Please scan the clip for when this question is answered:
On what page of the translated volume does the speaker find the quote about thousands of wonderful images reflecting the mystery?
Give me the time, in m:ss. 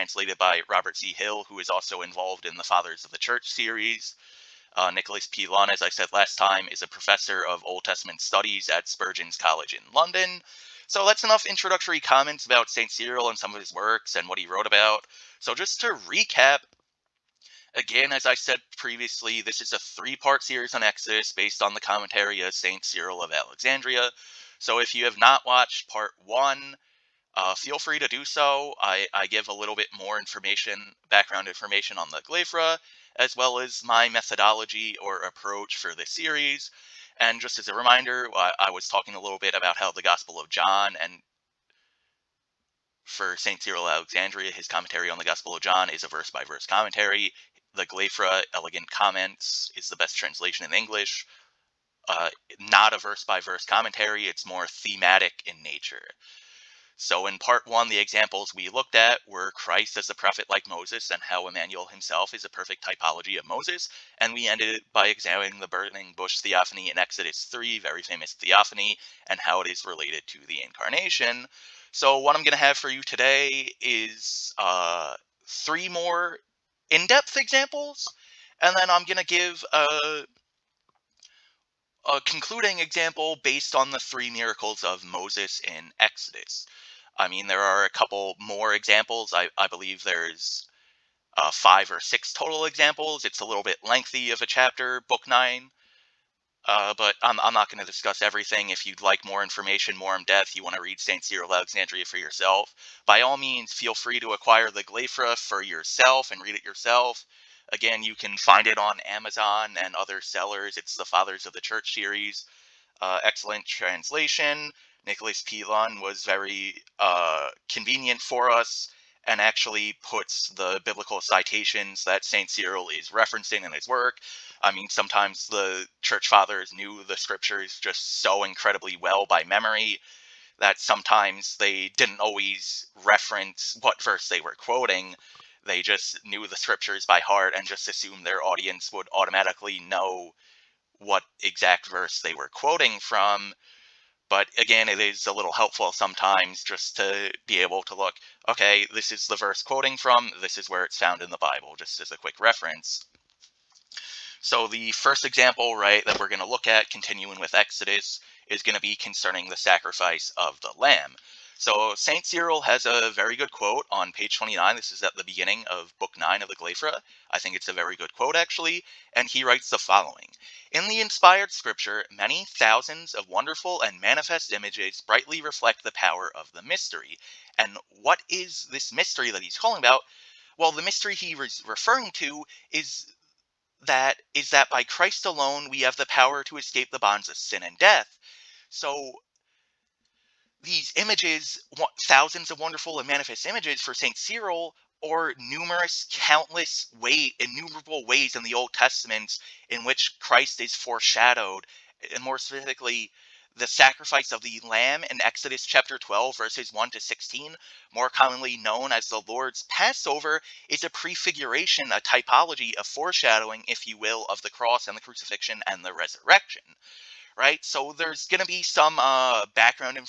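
2:44.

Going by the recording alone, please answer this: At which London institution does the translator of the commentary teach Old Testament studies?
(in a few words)
Spurgeon's College.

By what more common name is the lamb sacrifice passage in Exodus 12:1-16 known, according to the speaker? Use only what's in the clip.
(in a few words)
The Lord's Passover.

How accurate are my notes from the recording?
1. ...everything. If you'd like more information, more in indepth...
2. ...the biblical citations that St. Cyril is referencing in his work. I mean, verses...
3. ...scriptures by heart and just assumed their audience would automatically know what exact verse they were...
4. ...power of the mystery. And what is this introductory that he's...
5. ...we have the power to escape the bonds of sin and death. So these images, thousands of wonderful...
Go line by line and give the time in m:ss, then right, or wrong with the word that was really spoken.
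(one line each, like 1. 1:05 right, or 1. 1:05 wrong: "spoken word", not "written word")
1. 1:38 wrong: "depth", not "indepth"
2. 2:00 wrong: "sometimes", not "verses"
3. 2:16 right
4. 2:55 wrong: "mystery", not "introductory"
5. 3:05 right.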